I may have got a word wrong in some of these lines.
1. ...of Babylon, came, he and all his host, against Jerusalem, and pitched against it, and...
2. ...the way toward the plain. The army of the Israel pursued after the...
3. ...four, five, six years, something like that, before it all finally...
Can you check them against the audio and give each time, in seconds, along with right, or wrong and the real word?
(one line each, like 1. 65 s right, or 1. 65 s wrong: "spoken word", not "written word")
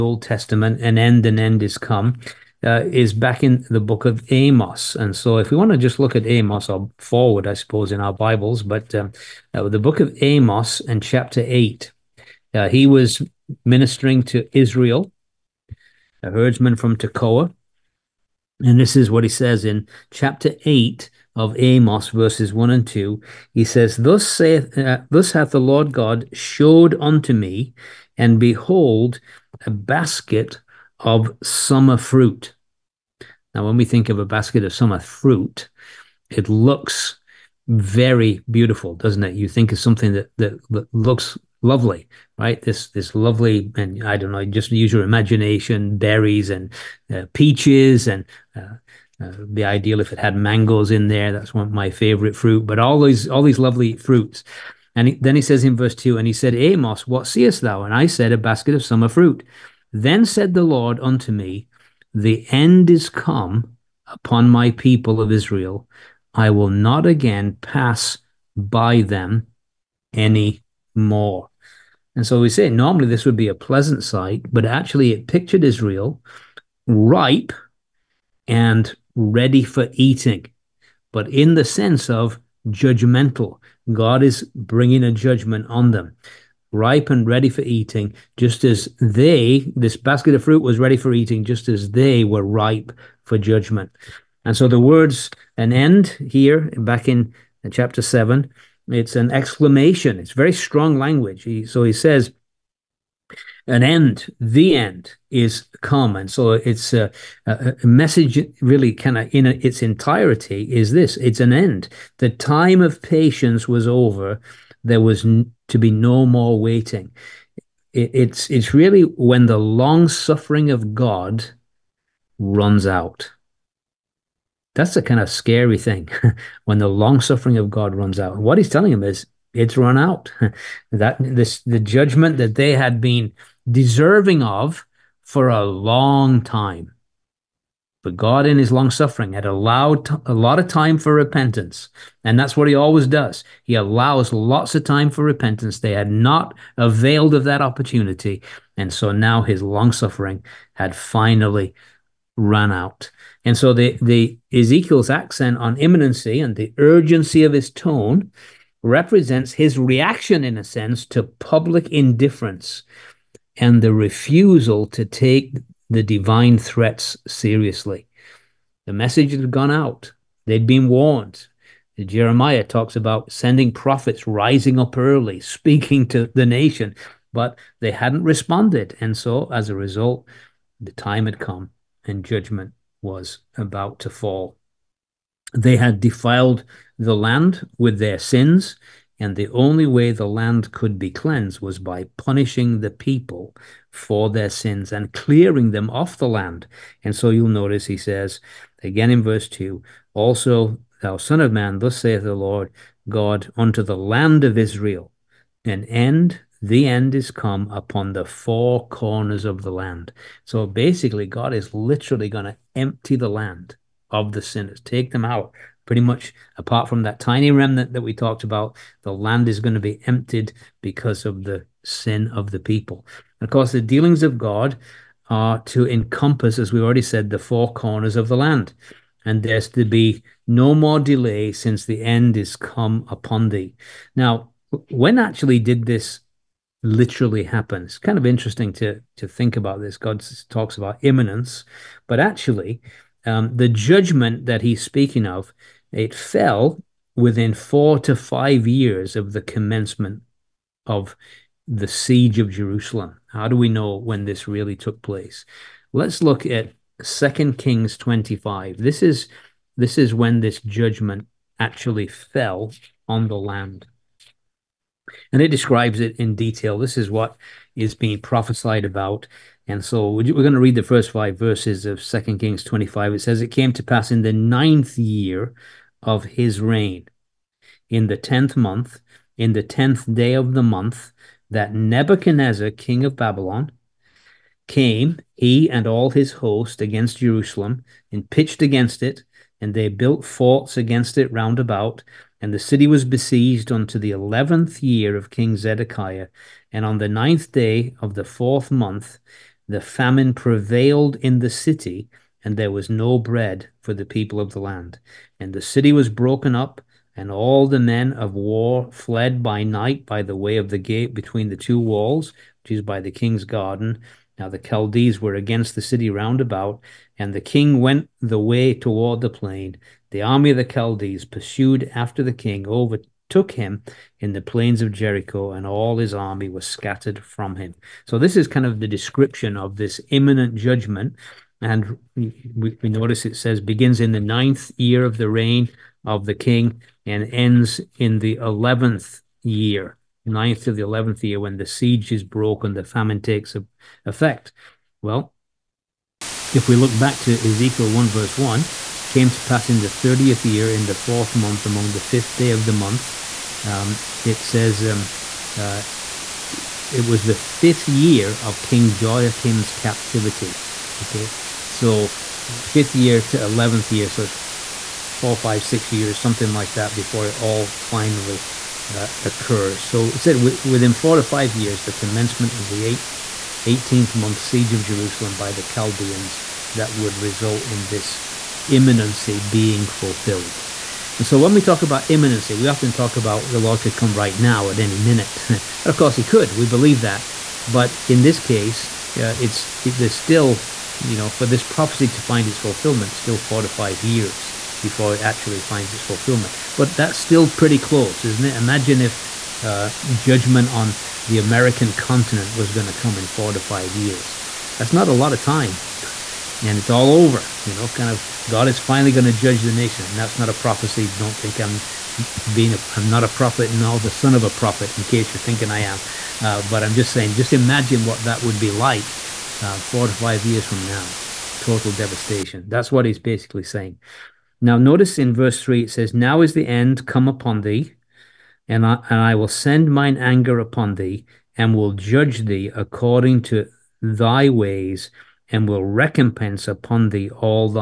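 1. 283 s right
2. 318 s wrong: "Chaldees", not "Israel"
3. 365 s right.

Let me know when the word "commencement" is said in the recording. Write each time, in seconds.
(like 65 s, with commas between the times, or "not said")
249 s, 371 s.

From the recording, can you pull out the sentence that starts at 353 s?
Um, it says, um, uh, it was the fifth year of King Jehoiachin's captivity.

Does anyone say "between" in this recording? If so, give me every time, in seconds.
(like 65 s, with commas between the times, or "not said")
311 s.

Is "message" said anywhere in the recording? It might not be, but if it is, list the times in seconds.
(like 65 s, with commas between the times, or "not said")
107 s, 168 s.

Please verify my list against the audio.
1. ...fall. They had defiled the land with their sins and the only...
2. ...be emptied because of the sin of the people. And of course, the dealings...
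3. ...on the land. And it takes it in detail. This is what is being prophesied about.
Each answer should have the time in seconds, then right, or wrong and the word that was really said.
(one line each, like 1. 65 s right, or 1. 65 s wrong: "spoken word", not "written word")
1. 184 s right
2. 219 s right
3. 263 s wrong: "describes", not "takes".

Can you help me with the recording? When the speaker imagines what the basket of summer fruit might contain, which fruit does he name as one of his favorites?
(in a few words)
mangoes.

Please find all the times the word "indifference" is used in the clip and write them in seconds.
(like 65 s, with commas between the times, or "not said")
161 s.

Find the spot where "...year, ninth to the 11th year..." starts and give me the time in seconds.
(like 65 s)
339 s.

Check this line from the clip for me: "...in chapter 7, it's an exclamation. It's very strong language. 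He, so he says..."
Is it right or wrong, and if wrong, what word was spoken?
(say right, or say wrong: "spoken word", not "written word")
right.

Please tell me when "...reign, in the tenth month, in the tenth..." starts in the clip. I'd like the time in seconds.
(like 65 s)
276 s.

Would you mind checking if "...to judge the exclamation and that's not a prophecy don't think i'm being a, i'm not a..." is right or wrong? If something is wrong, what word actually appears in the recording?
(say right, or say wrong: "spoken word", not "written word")
wrong: "nation", not "exclamation".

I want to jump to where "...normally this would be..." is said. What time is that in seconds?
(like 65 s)
72 s.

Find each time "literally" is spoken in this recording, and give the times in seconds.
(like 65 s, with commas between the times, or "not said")
211 s, 236 s.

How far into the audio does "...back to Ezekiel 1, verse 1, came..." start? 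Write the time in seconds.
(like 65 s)
346 s.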